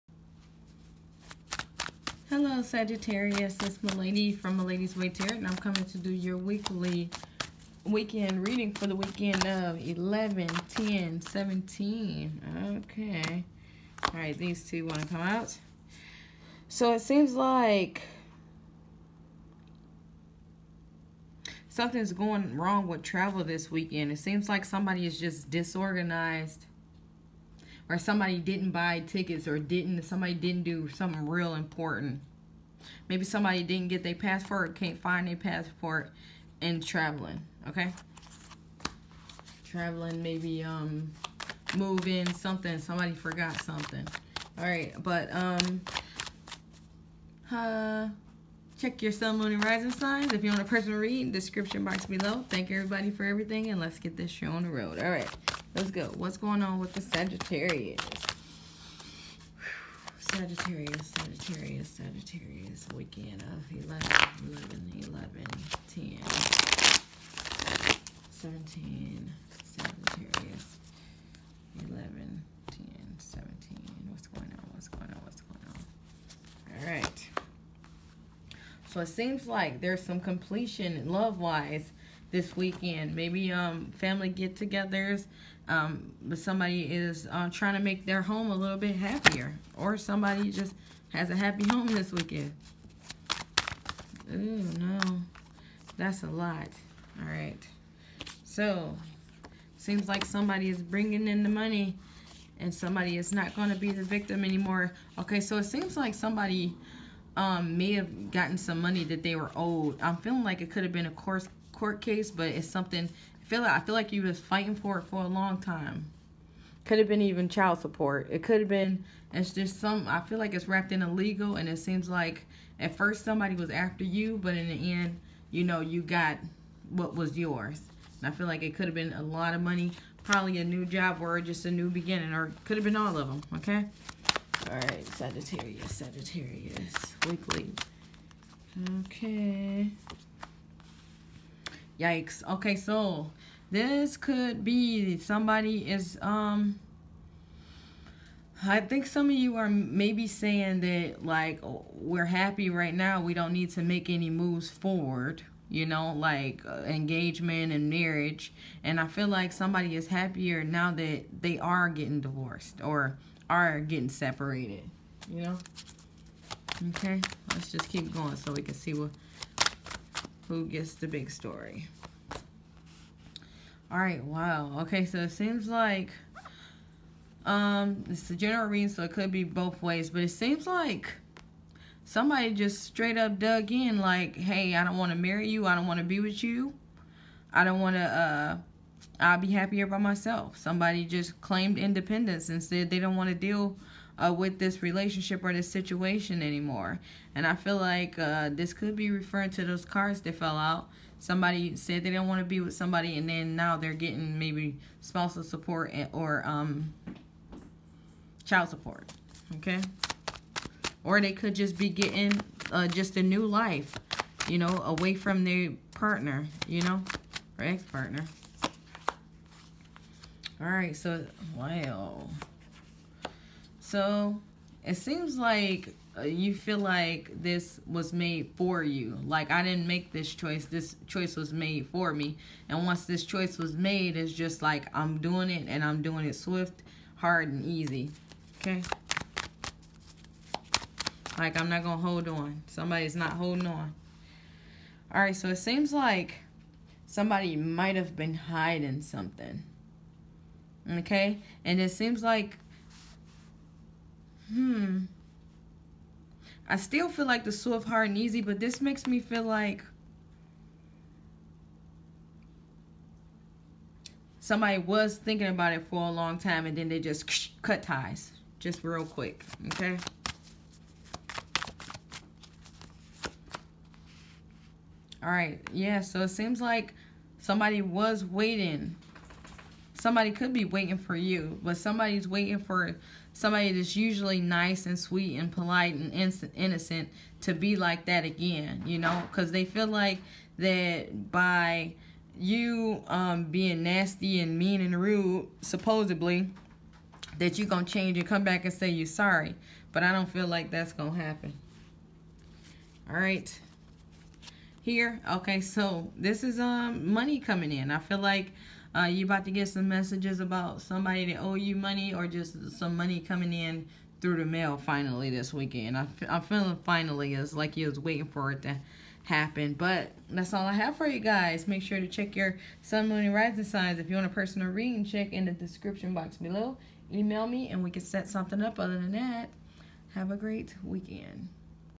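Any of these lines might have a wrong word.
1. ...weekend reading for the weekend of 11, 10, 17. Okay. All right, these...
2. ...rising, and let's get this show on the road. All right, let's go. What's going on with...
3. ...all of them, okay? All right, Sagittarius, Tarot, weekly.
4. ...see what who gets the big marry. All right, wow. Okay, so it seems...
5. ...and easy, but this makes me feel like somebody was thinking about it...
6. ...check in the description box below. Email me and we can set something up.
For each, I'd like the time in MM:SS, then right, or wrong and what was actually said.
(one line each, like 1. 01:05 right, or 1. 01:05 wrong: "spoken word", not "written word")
1. 00:07 right
2. 00:53 wrong: "everything", not "rising"
3. 02:12 wrong: "Sagittarius", not "Tarot"
4. 02:48 wrong: "story", not "marry"
5. 04:18 right
6. 05:25 right.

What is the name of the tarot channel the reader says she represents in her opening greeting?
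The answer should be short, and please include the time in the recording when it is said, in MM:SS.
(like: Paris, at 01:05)
Malady's Way Tarot, at 00:04.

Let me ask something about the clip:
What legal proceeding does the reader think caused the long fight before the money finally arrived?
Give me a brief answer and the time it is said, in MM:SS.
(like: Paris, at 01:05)
Court case, at 01:51.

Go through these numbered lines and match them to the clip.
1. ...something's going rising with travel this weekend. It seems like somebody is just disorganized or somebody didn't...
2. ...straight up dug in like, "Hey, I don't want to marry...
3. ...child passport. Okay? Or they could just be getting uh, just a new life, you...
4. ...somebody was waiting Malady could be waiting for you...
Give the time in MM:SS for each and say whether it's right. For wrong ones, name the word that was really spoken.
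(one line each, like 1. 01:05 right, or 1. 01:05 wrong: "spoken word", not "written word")
1. 00:21 wrong: "wrong", not "rising"
2. 03:02 right
3. 03:28 wrong: "support", not "passport"
4. 04:37 wrong: "Somebody", not "Malady".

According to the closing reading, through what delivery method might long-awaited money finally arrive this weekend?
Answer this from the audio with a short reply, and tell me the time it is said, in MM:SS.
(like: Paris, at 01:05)
The mail, at 05:14.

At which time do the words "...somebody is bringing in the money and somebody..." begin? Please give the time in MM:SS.
01:40.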